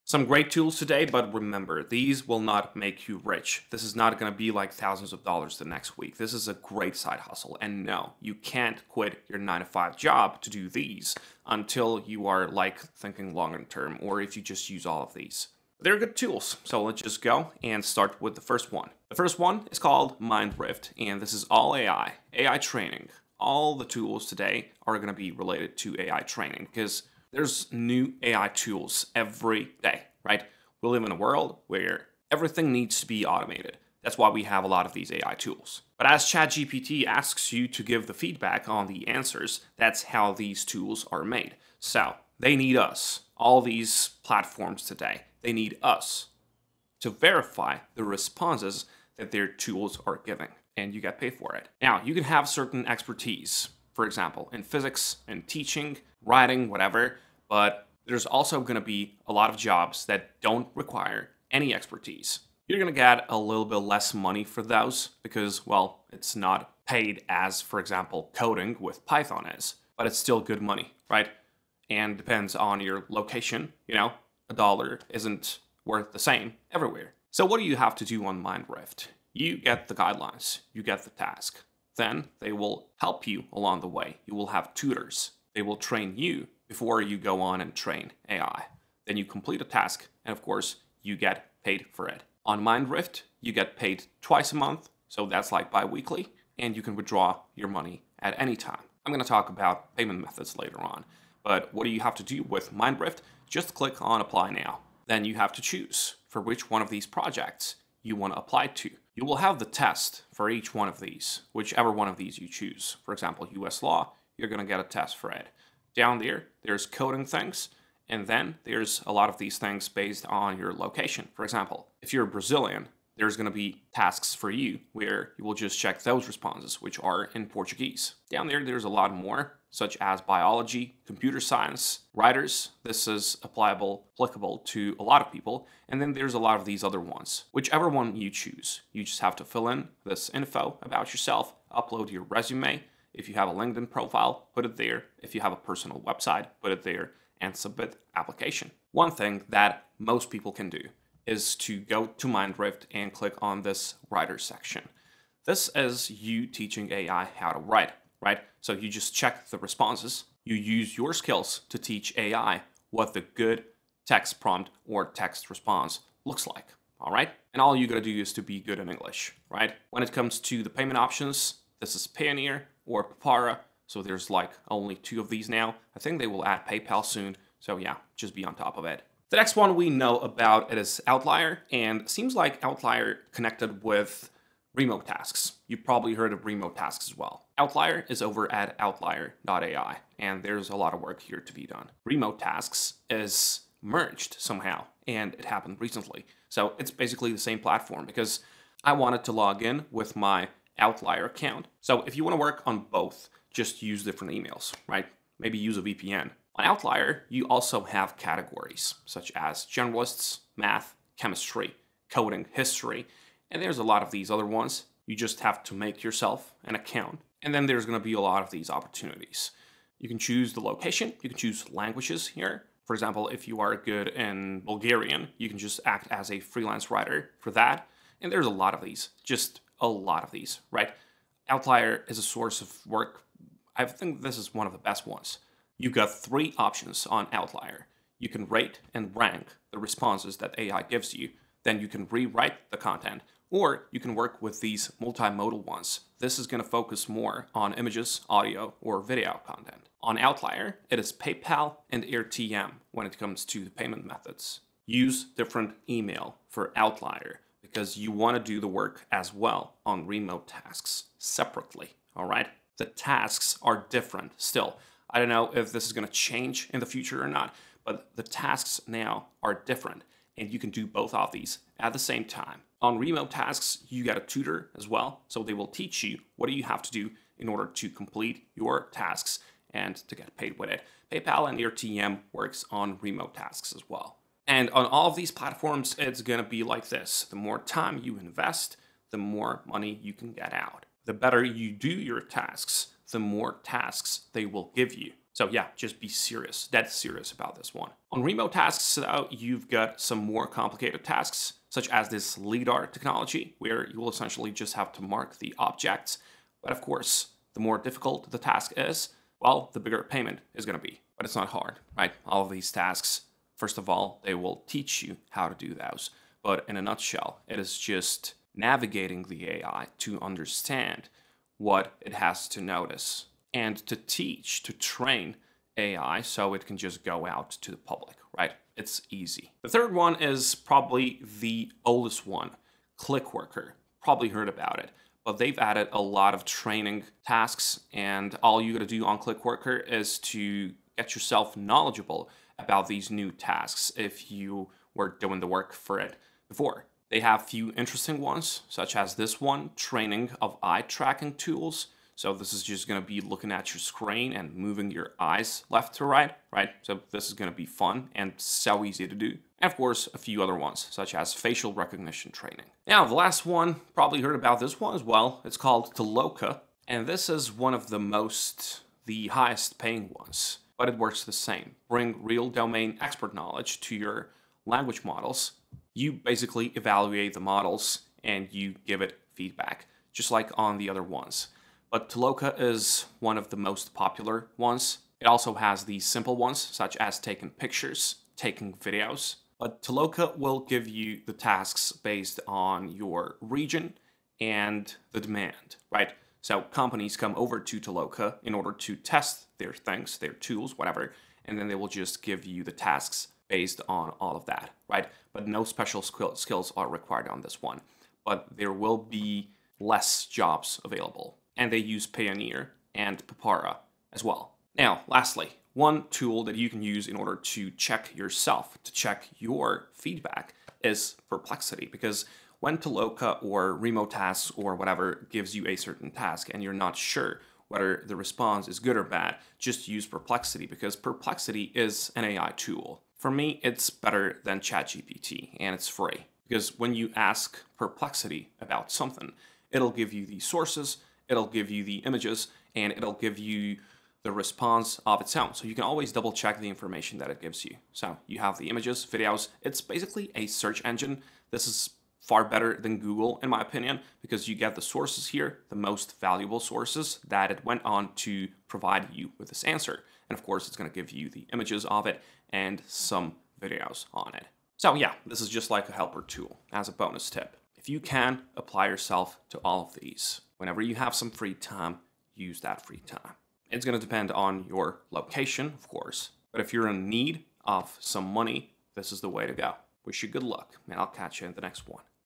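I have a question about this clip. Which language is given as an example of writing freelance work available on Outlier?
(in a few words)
Bulgarian.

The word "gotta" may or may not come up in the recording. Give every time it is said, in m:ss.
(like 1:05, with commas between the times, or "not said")
2:47, 5:38.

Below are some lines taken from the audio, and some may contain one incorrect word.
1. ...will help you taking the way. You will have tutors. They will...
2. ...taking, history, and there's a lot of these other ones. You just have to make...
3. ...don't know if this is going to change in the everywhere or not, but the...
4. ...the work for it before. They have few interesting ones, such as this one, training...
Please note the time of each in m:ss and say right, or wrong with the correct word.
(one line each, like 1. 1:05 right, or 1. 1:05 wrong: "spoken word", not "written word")
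1. 1:22 wrong: "along", not "taking"
2. 3:32 wrong: "coding", not "taking"
3. 4:25 wrong: "future", not "everywhere"
4. 5:45 right.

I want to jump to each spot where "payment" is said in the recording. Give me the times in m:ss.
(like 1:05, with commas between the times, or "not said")
1:39, 2:50, 4:13, 5:10.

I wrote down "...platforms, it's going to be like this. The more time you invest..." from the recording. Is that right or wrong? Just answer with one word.
right.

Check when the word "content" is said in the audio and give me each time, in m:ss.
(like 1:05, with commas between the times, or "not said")
4:02, 4:09.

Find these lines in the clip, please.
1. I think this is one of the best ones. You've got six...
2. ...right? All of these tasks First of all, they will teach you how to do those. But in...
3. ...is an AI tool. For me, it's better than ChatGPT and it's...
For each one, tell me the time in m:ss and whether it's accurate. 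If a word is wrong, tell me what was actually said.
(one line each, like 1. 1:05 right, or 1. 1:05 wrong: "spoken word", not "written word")
1. 3:53 wrong: "three", not "six"
2. 5:11 right
3. 7:11 right.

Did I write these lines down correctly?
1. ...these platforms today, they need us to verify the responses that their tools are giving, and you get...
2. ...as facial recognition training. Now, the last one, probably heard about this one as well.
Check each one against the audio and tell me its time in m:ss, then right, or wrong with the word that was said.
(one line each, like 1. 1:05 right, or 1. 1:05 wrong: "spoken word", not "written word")
1. 0:43 right
2. 6:01 right.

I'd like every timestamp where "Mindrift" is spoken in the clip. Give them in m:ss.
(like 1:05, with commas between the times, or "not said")
0:20, 1:18, 1:32, 1:42, 2:32.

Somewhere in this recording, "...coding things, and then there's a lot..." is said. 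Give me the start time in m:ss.
1:56.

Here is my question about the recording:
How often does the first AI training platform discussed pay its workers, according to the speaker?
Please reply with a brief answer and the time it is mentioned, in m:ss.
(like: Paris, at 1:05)
Twice a month, at 1:34.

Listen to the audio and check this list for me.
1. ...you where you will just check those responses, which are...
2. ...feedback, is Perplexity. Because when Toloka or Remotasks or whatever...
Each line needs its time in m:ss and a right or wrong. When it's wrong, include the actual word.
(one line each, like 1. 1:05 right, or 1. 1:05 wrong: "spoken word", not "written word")
1. 2:04 right
2. 6:59 right.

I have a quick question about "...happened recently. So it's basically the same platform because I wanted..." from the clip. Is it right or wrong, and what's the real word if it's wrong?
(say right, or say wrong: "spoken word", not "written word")
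right.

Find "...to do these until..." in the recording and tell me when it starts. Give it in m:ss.
0:10.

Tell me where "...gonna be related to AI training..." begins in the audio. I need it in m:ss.
0:24.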